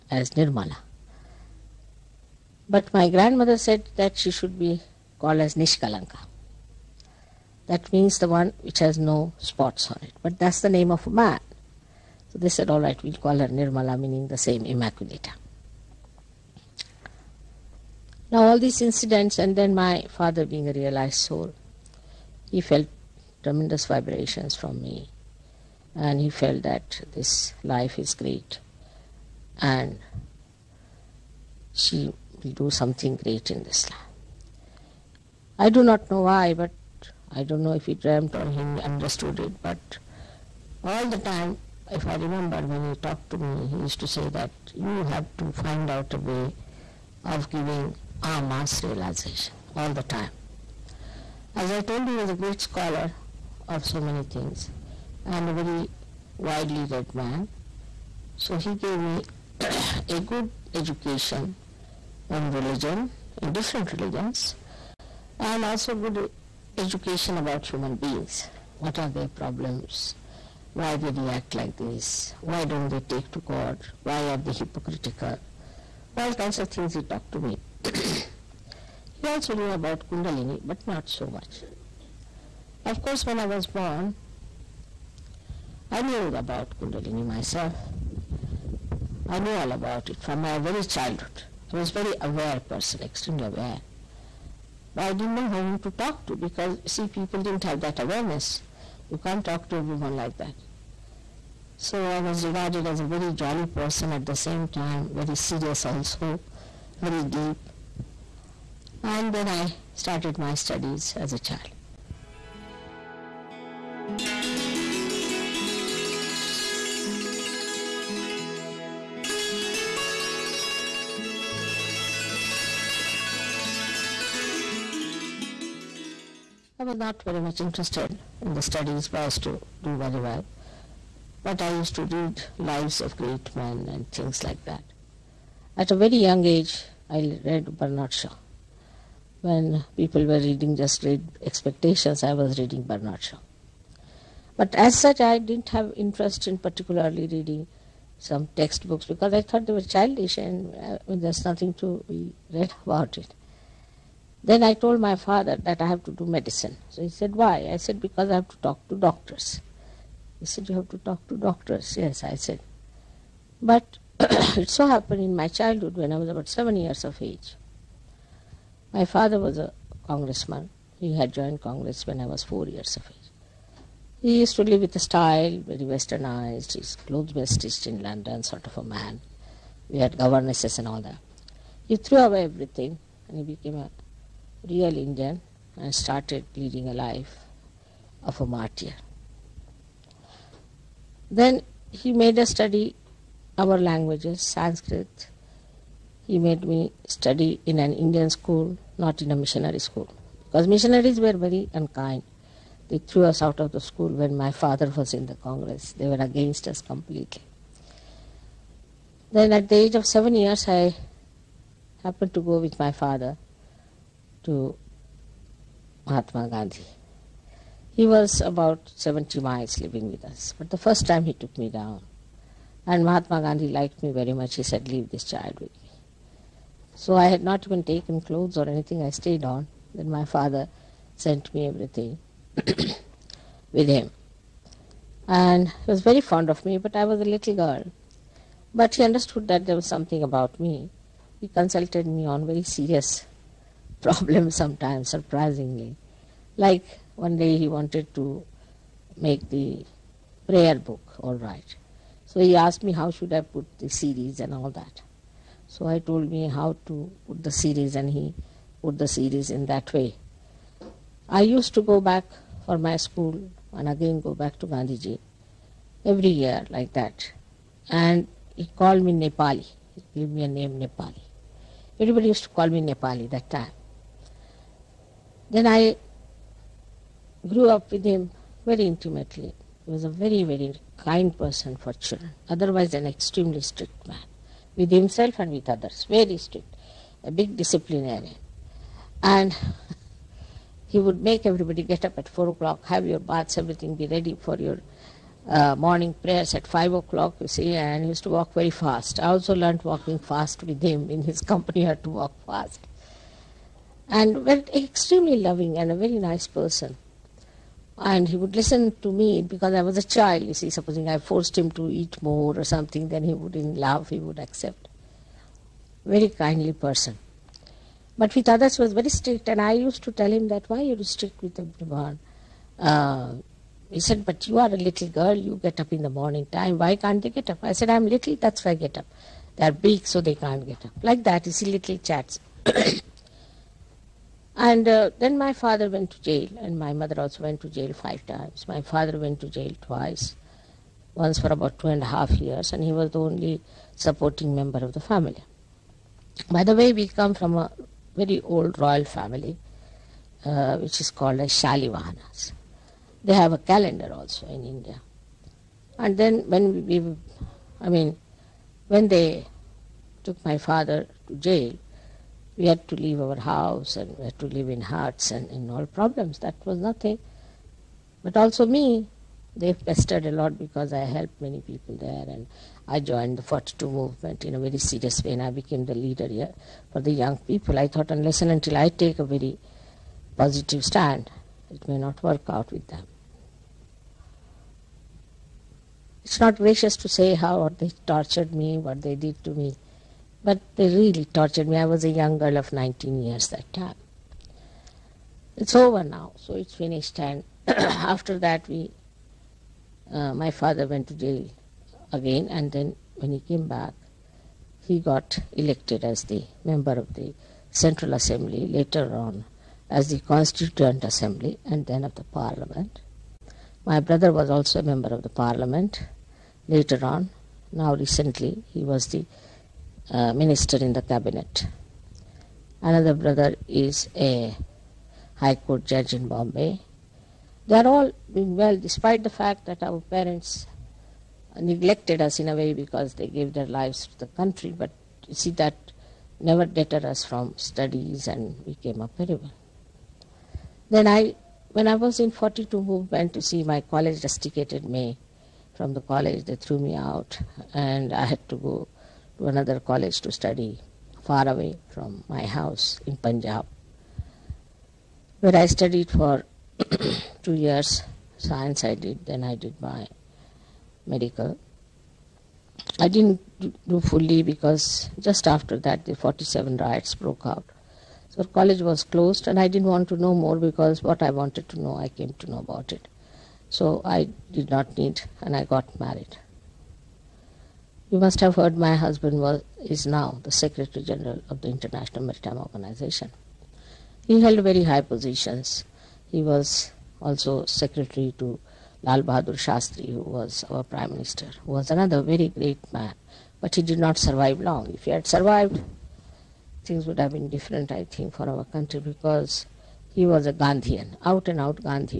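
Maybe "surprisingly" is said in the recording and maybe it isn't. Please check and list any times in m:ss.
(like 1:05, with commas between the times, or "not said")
4:05.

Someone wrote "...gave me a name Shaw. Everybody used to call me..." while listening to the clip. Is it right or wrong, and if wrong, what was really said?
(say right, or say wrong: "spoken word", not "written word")
wrong: "Nepali", not "Shaw".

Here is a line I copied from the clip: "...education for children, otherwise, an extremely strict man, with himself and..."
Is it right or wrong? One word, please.
wrong.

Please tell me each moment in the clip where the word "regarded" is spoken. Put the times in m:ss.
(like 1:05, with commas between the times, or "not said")
1:42.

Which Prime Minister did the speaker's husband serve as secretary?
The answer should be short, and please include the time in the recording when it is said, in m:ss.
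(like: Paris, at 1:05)
Lal Bahadur Shastri, at 8:09.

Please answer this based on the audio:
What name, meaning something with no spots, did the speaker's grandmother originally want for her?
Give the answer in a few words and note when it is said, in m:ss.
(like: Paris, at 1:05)
Nishkalanka, at 0:05.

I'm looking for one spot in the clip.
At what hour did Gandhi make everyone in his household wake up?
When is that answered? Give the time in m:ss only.
4:52.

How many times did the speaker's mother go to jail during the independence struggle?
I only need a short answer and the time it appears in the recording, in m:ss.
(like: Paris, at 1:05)
5, at 5:37.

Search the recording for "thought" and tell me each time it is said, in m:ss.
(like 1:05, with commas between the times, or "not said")
2:29, 6:17.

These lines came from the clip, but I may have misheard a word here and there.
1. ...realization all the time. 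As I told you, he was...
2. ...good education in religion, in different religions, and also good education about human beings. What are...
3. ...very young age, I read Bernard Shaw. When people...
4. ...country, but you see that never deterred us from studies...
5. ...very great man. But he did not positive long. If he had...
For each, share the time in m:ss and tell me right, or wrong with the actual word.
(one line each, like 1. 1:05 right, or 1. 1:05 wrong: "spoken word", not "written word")
1. 0:48 right
2. 1:00 right
3. 2:15 right
4. 7:14 right
5. 8:12 wrong: "survive", not "positive".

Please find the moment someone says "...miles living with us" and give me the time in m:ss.
3:39.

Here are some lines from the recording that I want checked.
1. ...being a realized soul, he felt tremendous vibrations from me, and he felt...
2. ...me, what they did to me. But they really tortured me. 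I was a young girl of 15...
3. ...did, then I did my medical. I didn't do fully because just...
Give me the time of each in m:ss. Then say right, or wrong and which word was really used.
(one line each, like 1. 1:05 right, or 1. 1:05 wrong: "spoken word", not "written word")
1. 0:20 right
2. 6:28 wrong: "19", not "15"
3. 7:38 right.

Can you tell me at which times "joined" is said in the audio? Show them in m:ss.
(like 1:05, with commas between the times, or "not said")
2:51, 6:13.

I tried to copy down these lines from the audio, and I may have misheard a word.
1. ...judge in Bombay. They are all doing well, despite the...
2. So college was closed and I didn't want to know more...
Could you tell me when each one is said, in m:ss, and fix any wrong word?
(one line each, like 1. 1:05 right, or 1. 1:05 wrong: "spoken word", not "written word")
1. 7:05 right
2. 7:48 right.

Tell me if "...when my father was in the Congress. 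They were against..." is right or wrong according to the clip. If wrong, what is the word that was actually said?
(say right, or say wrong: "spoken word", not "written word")
right.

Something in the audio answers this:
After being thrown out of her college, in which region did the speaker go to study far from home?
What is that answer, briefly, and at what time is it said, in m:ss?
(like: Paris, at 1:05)
Punjab, at 7:33.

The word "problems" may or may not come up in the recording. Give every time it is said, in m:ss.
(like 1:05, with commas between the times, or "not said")
1:09, 4:04, 6:05.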